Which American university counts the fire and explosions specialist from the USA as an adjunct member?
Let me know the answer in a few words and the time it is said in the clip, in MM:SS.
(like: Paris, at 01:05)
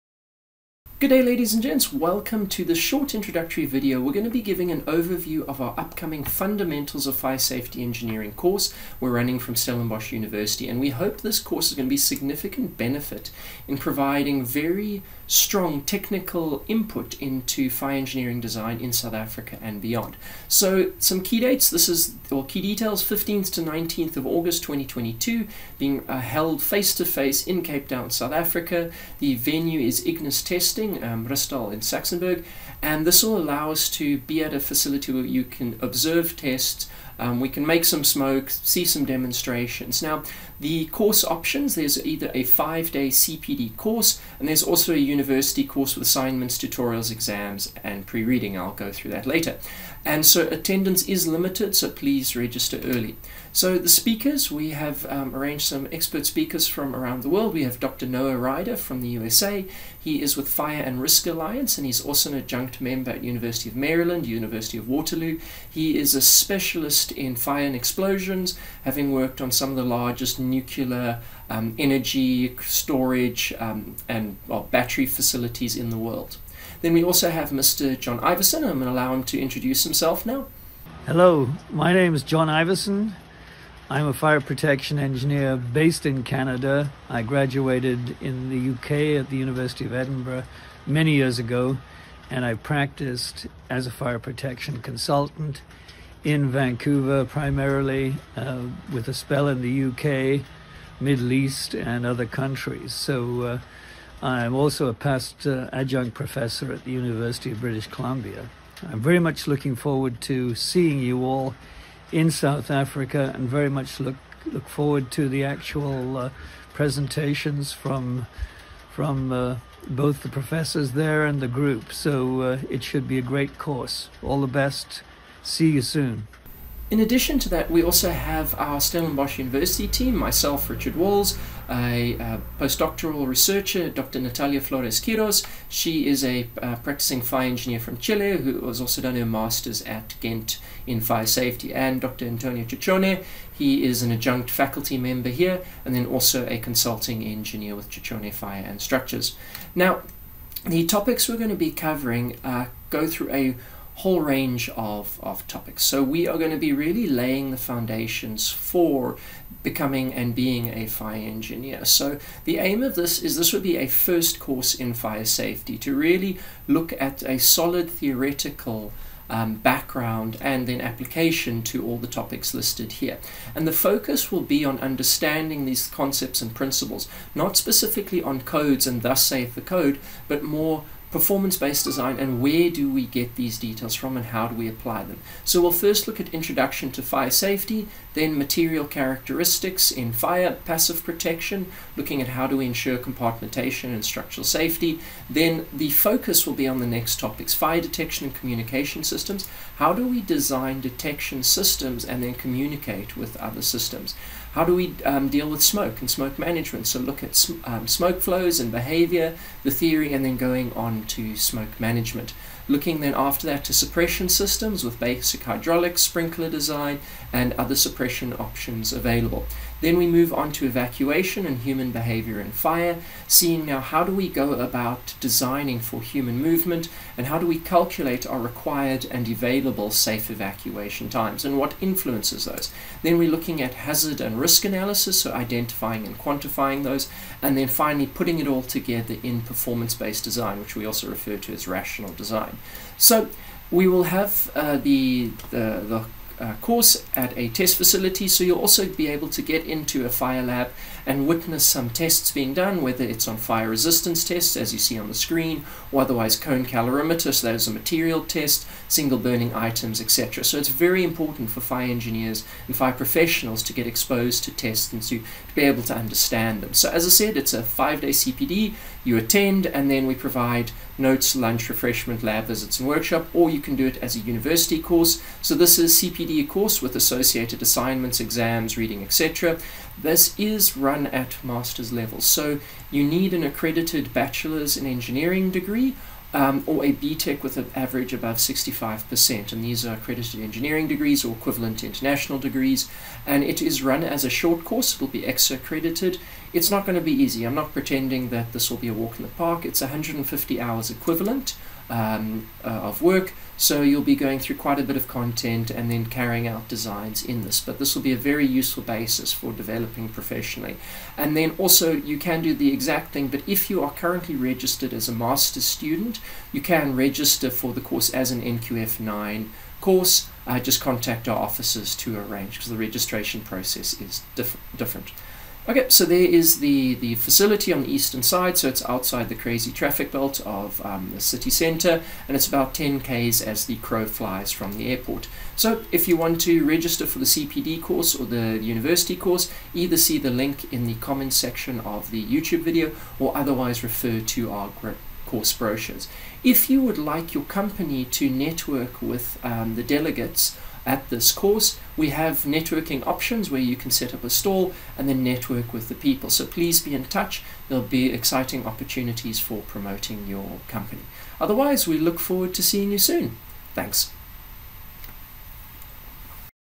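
University of Maryland, at 01:03.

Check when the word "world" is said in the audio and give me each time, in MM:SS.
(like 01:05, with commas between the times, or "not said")
00:57, 01:15.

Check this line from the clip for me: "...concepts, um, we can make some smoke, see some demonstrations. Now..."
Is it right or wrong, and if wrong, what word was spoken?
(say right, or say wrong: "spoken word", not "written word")
wrong: "tests", not "concepts".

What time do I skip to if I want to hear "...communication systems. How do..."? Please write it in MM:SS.
03:18.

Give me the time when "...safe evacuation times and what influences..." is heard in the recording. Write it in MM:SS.
03:49.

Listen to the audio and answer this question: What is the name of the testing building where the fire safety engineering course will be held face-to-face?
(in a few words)
Ignis Testing.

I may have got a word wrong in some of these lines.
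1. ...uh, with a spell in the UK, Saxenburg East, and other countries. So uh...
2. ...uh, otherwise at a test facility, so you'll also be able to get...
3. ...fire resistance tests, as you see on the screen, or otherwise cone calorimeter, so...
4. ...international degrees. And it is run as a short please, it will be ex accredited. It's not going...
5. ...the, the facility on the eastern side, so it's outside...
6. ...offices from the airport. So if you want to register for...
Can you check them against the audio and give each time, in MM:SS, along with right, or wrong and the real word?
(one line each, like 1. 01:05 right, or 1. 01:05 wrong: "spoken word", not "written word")
1. 01:38 wrong: "Middle", not "Saxenburg"
2. 04:06 wrong: "course", not "otherwise"
3. 04:13 right
4. 04:51 wrong: "course", not "please"
5. 05:26 right
6. 05:34 wrong: "flies", not "offices".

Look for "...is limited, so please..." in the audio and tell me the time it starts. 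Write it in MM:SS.
00:51.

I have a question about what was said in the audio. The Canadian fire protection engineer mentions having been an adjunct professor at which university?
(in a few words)
University of British Columbia.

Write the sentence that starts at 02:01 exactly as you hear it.
So uh, it should be a great course.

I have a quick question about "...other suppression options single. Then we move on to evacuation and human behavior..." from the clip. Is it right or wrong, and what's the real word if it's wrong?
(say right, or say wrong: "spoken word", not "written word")
wrong: "available", not "single".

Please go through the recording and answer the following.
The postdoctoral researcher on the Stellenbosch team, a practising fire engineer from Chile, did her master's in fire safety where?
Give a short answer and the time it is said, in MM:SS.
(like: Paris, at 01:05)
Ghent, at 02:20.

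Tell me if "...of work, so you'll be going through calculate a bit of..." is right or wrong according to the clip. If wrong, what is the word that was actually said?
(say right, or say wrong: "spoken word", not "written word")
wrong: "quite", not "calculate".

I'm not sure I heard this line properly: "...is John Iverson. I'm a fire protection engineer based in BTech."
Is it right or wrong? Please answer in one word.
wrong.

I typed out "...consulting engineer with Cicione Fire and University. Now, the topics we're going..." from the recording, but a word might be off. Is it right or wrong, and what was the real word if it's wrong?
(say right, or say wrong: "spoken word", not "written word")
wrong: "Structures", not "University".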